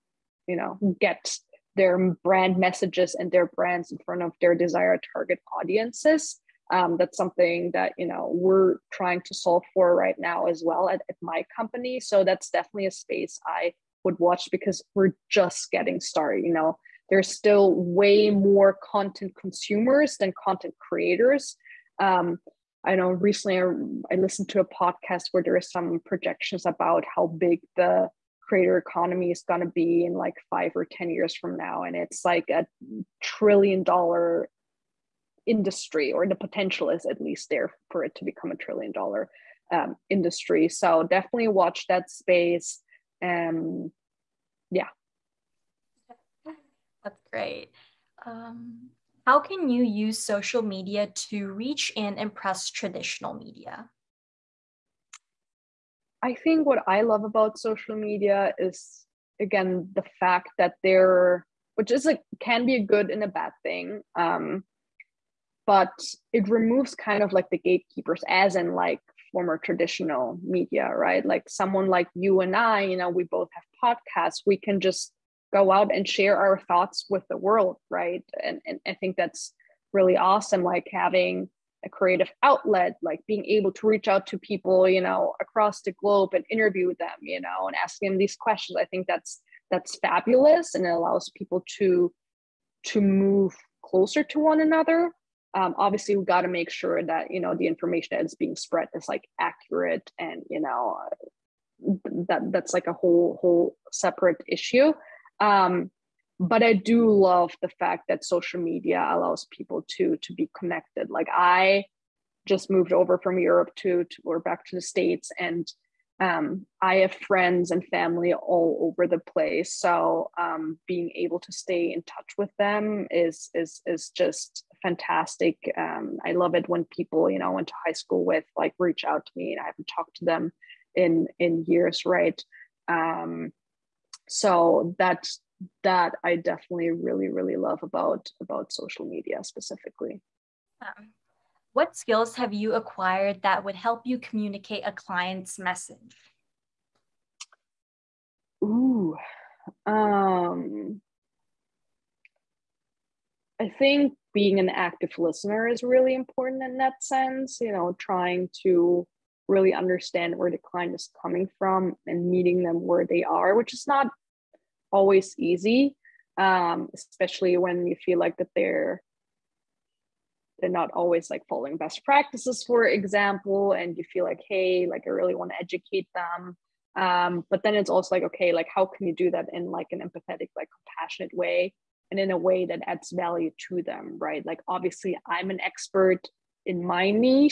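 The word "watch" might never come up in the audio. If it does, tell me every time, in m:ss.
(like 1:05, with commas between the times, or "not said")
0:14, 0:41.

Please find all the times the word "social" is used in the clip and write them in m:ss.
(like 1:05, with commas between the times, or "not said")
0:50, 0:57, 1:48, 2:18.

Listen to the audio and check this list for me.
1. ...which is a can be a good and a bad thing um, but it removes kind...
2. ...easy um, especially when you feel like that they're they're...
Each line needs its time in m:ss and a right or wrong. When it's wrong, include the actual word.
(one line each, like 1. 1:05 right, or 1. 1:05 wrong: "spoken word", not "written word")
1. 1:01 right
2. 2:45 right.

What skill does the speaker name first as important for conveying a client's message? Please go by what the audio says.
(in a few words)
active listener.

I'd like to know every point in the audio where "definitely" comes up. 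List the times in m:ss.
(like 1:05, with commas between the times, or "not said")
0:12, 0:41, 2:16.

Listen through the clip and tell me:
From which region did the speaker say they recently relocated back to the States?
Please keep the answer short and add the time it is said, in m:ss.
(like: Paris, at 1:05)
Europe, at 1:53.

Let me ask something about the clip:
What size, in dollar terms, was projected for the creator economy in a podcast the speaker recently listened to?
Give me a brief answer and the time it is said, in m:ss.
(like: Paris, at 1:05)
a trillion dollar industry, at 0:32.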